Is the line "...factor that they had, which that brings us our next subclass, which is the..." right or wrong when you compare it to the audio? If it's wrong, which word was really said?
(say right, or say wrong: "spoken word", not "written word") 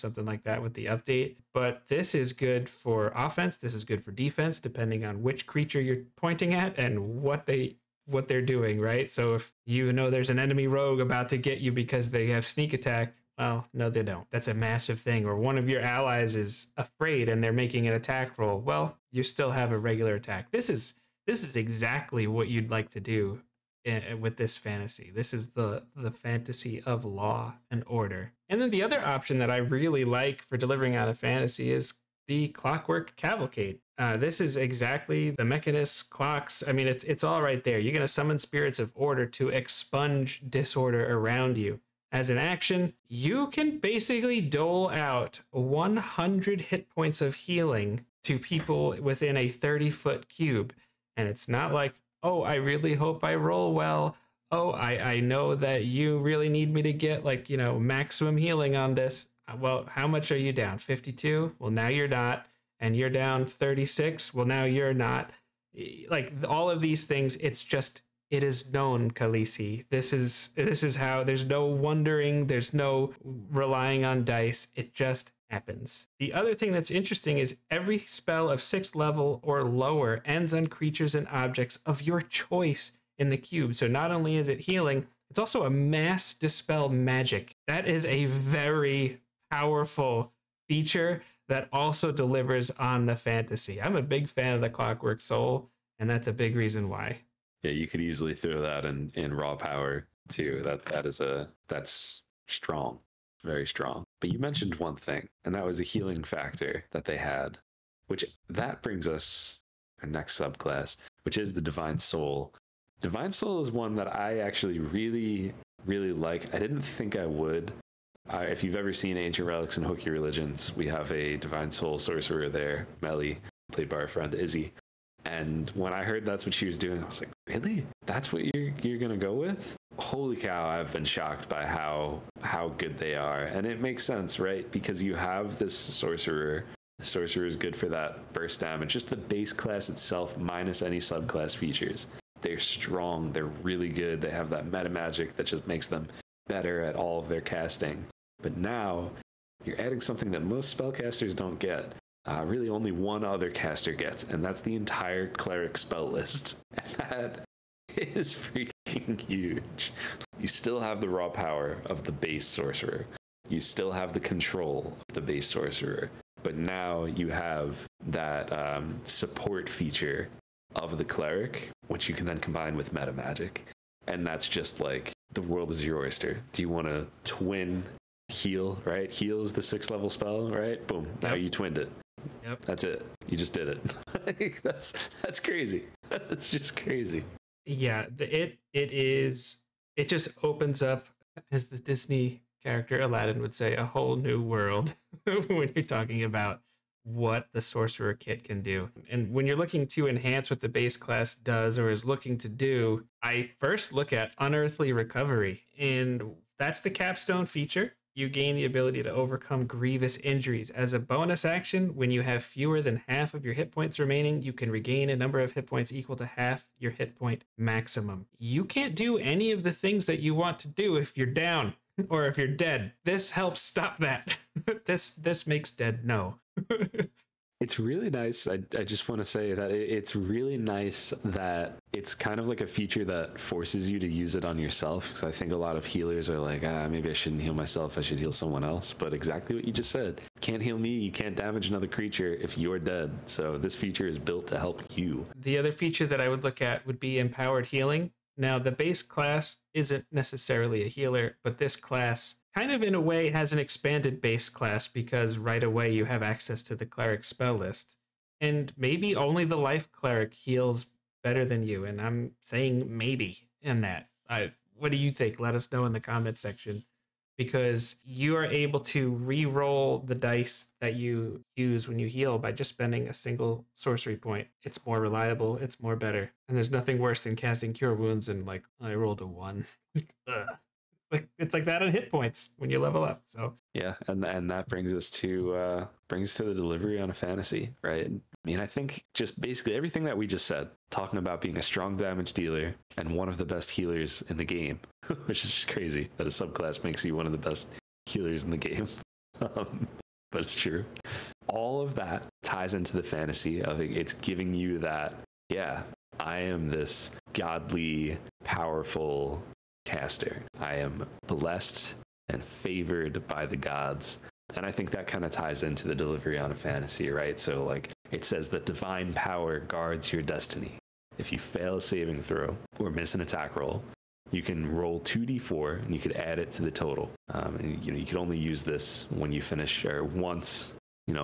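right.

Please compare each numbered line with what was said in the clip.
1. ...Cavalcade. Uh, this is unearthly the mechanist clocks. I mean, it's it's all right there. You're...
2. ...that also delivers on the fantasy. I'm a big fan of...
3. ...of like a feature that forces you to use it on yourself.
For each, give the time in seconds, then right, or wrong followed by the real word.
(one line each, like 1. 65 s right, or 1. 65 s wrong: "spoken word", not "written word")
1. 33 s wrong: "exactly", not "unearthly"
2. 91 s right
3. 232 s right.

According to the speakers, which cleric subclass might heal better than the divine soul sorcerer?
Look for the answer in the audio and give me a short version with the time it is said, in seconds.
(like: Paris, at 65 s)
Life cleric, at 259 s.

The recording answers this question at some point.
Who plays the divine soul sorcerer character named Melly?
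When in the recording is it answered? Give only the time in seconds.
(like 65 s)
124 s.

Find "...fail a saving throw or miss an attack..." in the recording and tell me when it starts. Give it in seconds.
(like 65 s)
321 s.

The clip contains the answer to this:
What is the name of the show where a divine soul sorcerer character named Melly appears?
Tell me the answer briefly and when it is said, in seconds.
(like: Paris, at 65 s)
Ancient Relics and Hooky Religions, at 119 s.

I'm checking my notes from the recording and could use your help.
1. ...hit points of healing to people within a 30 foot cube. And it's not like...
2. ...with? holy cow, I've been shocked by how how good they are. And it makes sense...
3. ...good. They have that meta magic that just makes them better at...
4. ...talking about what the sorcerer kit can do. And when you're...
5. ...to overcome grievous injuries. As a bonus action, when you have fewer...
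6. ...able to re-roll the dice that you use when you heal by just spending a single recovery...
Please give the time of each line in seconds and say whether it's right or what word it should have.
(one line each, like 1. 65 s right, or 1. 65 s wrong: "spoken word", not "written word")
1. 46 s right
2. 129 s right
3. 143 s right
4. 195 s right
5. 209 s right
6. 268 s wrong: "sorcery", not "recovery".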